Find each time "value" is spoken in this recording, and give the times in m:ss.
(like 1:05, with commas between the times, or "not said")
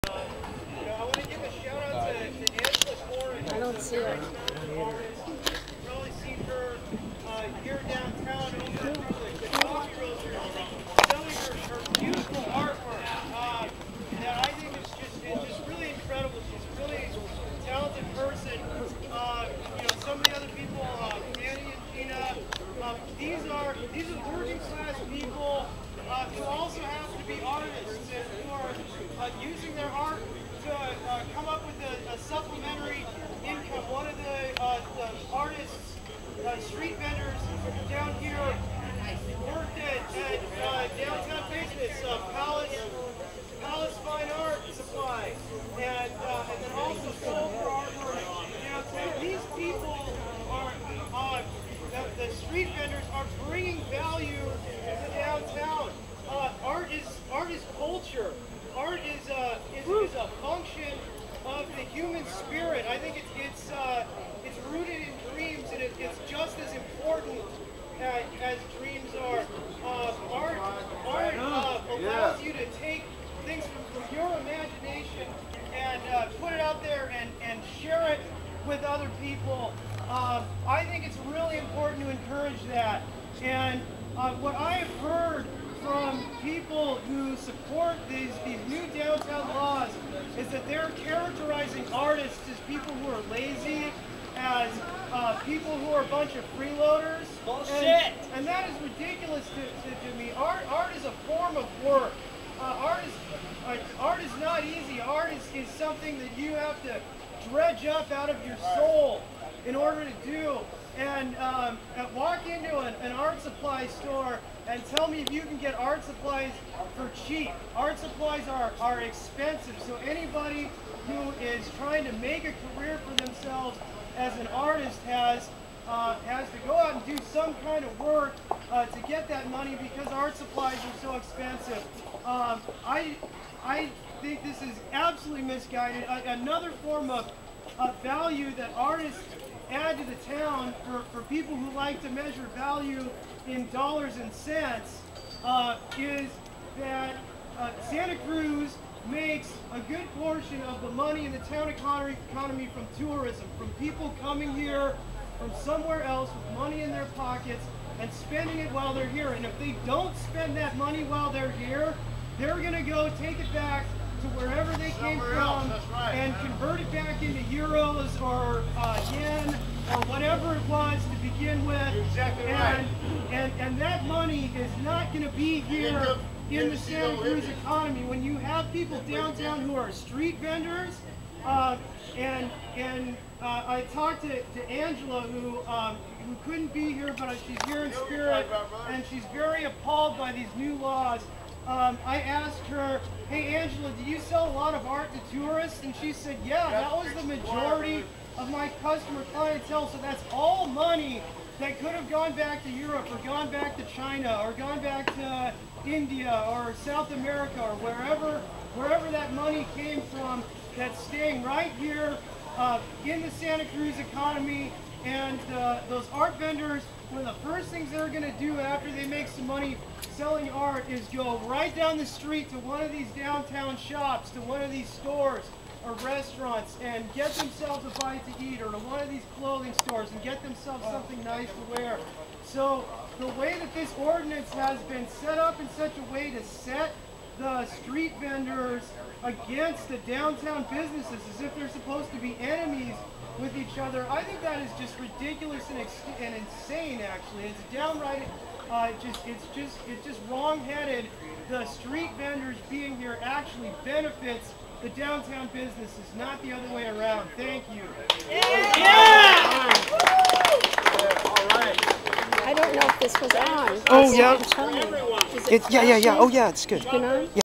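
0:53, 2:18, 2:22.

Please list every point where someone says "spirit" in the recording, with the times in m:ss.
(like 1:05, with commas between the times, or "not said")
1:02, 3:07.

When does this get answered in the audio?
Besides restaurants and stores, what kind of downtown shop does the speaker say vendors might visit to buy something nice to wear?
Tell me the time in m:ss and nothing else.
3:49.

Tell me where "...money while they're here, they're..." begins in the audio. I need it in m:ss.
2:40.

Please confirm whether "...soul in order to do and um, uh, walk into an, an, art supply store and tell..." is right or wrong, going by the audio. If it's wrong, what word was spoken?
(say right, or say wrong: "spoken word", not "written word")
right.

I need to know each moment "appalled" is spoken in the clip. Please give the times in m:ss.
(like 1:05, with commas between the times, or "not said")
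3:09.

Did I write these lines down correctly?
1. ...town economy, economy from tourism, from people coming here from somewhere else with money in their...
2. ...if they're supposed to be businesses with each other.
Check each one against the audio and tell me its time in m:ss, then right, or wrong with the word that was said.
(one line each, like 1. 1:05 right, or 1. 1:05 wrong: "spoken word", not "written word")
1. 2:31 right
2. 4:01 wrong: "enemies", not "businesses".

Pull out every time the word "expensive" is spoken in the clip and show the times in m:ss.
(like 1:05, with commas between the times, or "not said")
1:59, 2:11.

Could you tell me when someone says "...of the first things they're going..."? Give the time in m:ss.
3:37.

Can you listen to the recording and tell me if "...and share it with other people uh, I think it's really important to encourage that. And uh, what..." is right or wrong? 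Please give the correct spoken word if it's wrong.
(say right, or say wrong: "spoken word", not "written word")
right.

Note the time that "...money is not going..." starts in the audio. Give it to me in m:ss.
2:54.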